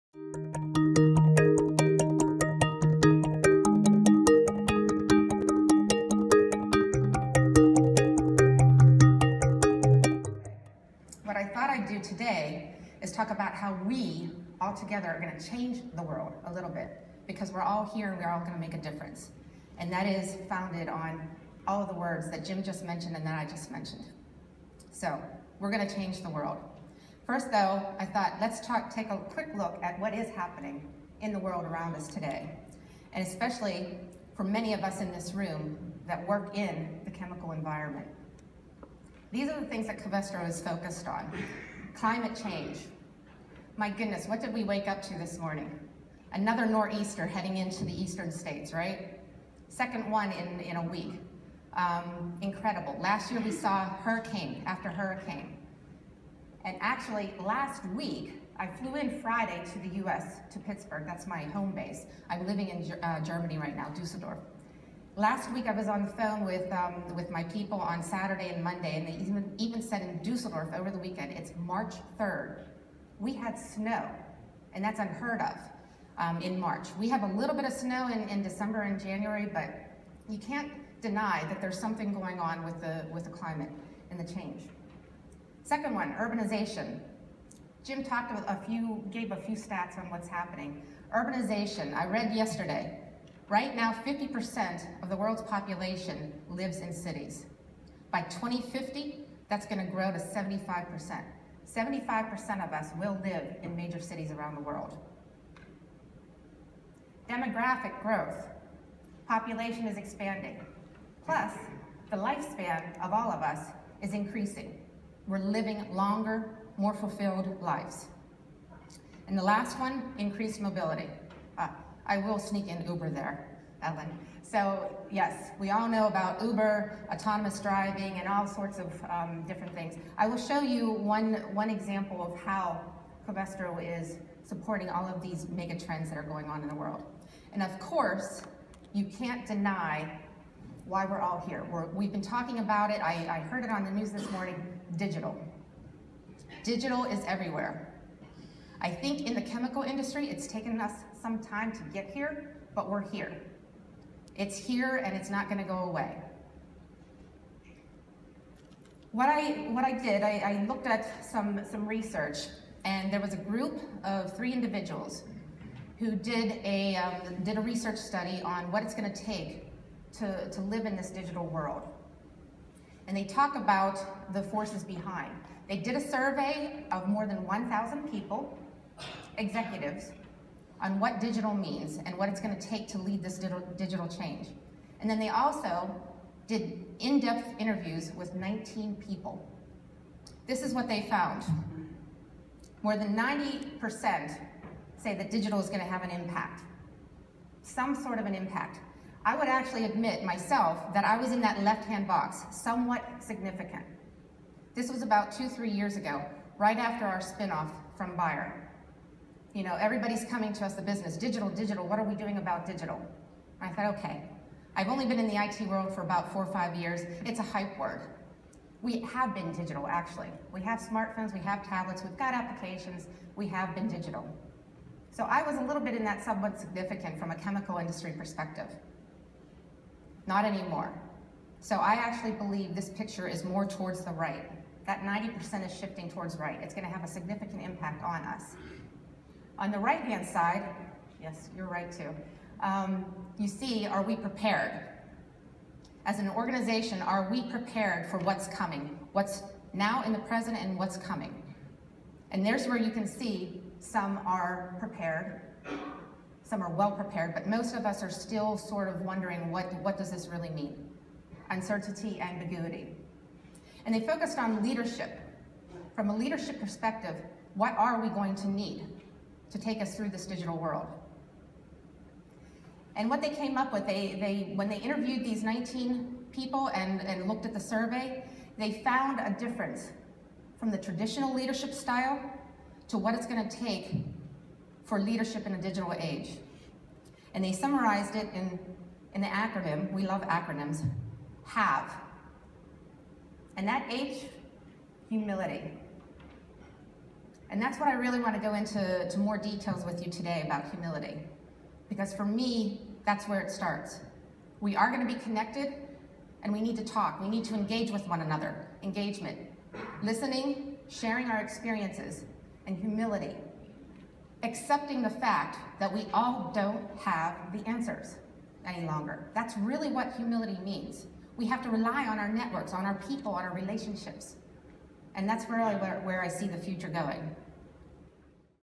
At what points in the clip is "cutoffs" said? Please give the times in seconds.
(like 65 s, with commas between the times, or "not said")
not said.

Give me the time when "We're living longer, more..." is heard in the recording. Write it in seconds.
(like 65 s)
115 s.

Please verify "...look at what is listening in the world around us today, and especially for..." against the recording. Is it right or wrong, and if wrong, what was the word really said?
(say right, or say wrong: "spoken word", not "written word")
wrong: "happening", not "listening".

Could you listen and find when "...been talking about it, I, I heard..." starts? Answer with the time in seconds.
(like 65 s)
142 s.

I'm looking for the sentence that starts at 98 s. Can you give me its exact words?
By 2050, that's gonna grow to 75%.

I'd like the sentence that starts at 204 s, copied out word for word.
This was about two, three years ago, right after our spinoff from Bayer.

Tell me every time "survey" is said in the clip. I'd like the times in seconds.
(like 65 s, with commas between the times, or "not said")
176 s, 277 s.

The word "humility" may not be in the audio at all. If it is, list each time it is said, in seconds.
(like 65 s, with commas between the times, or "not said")
295 s, 300 s, 312 s, 320 s.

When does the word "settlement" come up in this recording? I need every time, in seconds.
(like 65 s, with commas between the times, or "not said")
not said.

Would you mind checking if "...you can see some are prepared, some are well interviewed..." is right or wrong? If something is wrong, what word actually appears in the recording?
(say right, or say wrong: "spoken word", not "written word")
wrong: "prepared", not "interviewed".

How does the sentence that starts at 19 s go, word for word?
And that is founded on all of the words that Jim just mentioned and that I just mentioned.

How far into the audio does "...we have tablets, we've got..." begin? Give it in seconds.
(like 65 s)
221 s.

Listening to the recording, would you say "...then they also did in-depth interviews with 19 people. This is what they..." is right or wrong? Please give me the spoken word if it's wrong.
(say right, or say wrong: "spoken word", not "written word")
right.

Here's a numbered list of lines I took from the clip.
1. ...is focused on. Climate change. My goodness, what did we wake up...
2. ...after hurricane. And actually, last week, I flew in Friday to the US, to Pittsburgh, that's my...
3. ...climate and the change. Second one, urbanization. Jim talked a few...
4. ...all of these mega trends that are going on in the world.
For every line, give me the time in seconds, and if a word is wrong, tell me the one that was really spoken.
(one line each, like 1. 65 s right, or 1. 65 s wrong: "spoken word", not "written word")
1. 40 s right
2. 54 s right
3. 83 s right
4. 134 s right.